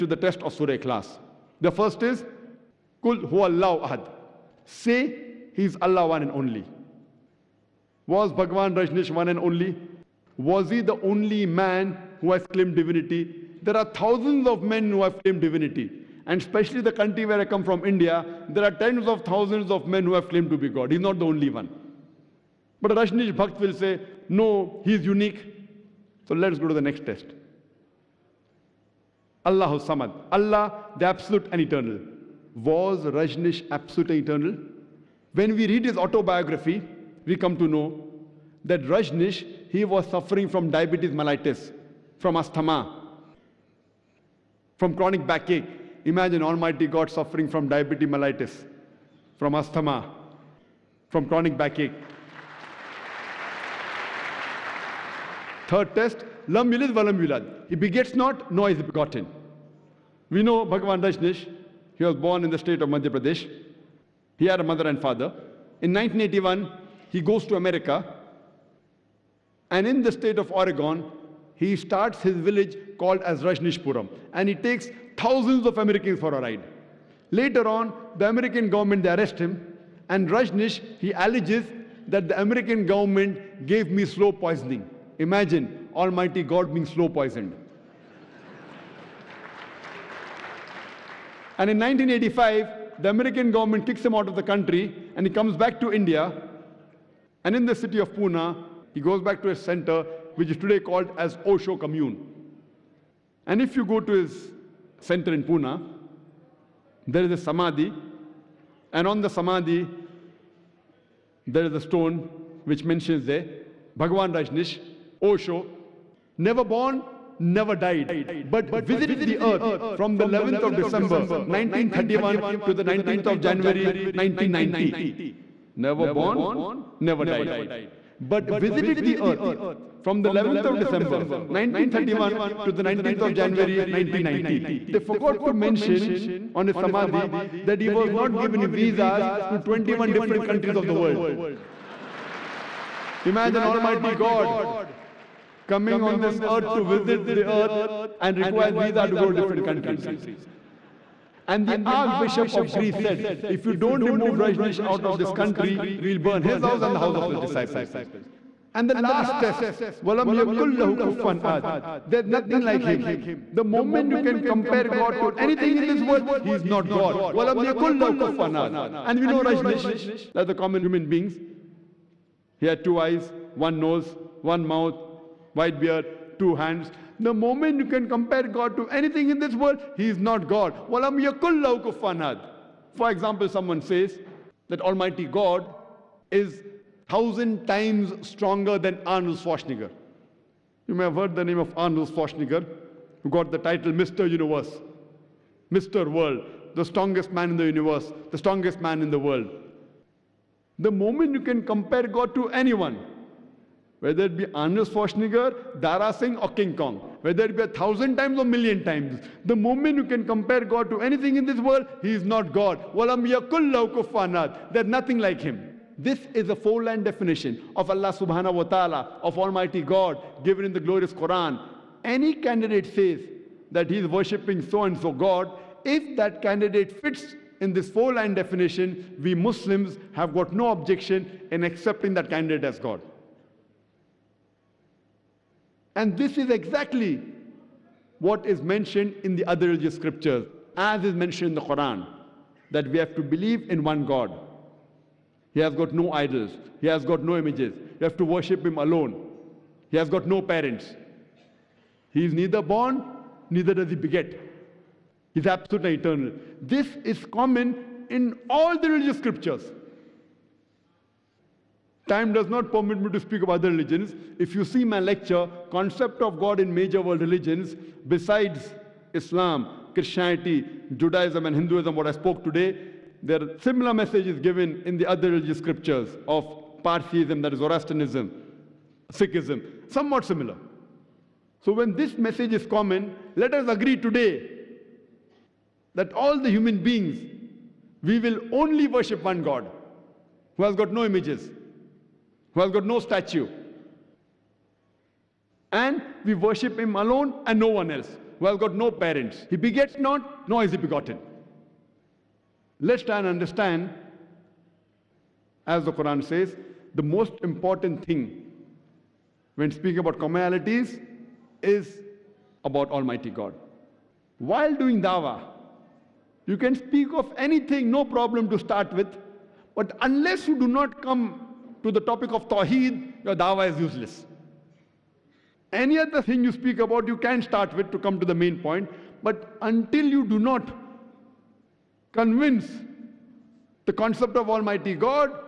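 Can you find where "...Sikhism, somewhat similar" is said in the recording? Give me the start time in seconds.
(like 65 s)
279 s.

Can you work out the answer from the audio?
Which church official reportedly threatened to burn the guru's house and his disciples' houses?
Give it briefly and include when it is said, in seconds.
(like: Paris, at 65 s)
The Archbishop of Greece, at 151 s.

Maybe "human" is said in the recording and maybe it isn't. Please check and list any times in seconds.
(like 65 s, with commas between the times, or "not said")
170 s, 286 s.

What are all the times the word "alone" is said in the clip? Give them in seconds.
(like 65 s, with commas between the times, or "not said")
248 s, 296 s.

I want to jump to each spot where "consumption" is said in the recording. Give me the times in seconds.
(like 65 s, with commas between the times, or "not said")
not said.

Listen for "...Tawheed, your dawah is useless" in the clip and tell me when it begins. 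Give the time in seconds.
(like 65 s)
322 s.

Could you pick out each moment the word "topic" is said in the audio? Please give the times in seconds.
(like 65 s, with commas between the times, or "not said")
321 s.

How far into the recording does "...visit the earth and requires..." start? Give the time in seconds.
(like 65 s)
146 s.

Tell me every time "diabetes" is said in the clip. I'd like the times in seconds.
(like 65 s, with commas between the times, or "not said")
40 s, 47 s.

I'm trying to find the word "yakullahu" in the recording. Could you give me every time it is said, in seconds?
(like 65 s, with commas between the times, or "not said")
160 s, 167 s.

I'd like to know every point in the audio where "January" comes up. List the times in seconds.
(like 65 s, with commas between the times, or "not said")
123 s, 133 s.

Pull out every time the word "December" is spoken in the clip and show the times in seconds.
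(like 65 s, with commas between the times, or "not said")
120 s, 130 s.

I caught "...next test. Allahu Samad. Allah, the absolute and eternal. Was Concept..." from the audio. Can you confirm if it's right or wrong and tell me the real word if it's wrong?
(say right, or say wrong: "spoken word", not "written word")
wrong: "Rajneesh", not "Concept".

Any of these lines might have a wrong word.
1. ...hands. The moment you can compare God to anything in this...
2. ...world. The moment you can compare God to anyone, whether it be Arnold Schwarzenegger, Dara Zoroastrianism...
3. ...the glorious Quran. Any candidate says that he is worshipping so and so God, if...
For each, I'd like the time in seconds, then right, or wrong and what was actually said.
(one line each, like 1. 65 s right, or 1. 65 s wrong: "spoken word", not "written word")
1. 176 s right
2. 199 s wrong: "Singh", not "Zoroastrianism"
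3. 220 s right.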